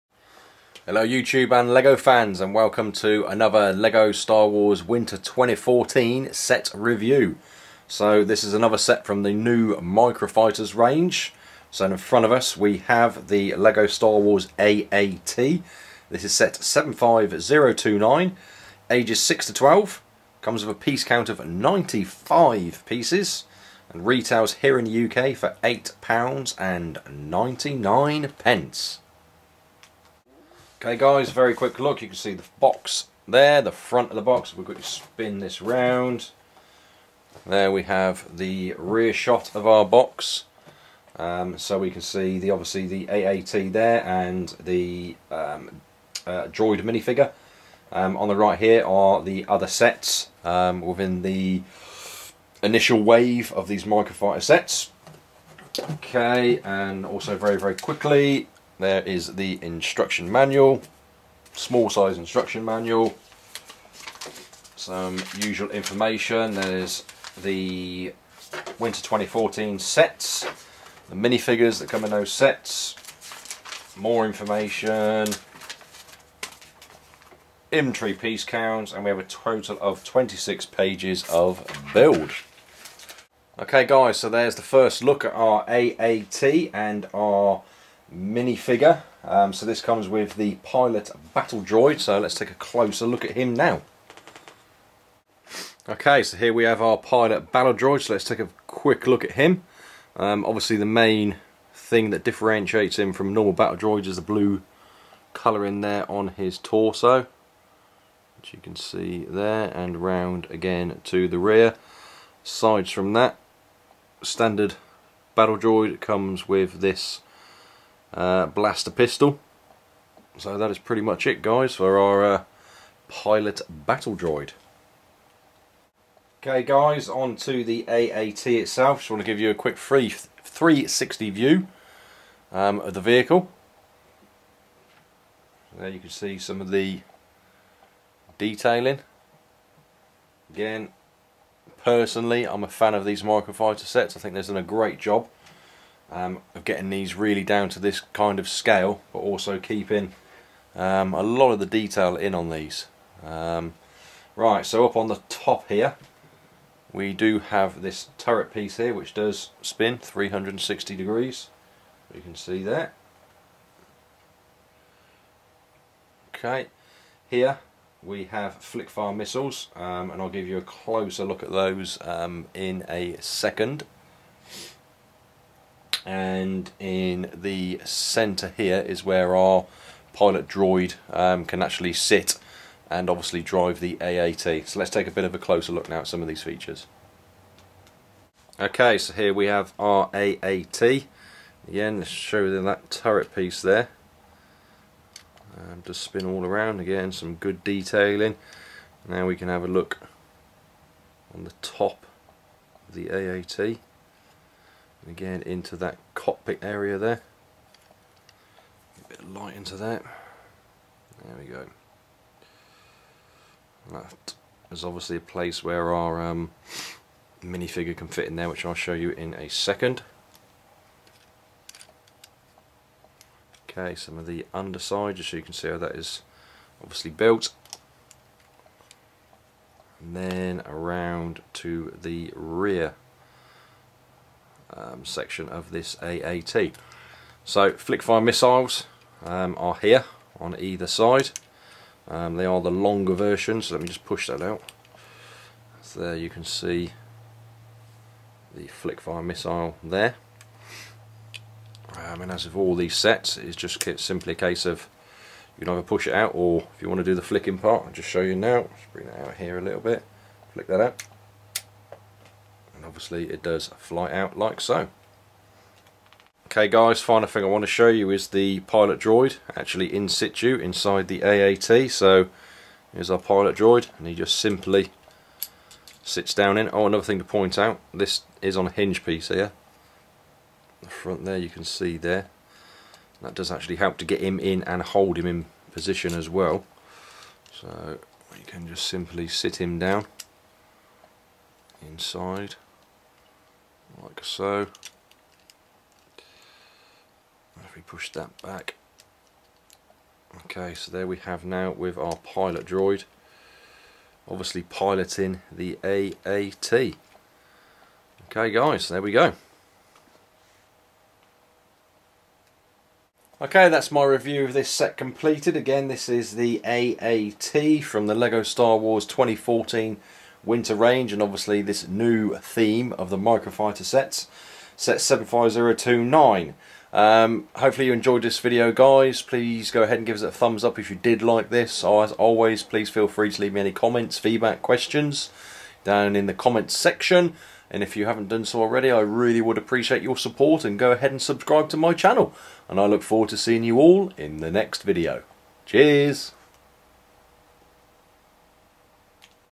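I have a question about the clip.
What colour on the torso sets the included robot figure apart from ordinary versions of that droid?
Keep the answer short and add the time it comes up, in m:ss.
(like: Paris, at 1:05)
Blue, at 1:44.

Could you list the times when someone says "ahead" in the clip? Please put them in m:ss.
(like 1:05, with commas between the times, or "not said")
5:29, 5:40.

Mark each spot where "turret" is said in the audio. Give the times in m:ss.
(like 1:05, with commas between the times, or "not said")
2:38, 3:12.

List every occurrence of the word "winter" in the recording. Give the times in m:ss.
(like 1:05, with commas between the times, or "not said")
0:04, 1:08, 5:20.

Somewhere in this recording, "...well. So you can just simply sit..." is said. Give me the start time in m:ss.
4:46.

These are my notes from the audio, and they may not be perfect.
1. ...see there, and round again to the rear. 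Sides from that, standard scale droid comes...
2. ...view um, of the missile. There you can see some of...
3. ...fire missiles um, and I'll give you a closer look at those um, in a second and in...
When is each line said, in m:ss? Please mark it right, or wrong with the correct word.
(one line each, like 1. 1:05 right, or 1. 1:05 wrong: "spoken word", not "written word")
1. 1:48 wrong: "battle", not "scale"
2. 2:11 wrong: "vehicle", not "missile"
3. 2:48 right.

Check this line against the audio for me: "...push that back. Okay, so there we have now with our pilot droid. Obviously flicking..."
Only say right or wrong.
wrong.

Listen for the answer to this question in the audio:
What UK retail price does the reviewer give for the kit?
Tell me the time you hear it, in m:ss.
0:25.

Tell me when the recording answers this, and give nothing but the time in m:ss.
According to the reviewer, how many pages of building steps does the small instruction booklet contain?
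1:20.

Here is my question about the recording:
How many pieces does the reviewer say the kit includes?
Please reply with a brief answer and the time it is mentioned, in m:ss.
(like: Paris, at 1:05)
95, at 0:21.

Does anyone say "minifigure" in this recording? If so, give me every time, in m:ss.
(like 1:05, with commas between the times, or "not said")
0:46, 1:11, 1:28, 3:37.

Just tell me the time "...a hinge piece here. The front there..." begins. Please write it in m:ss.
4:38.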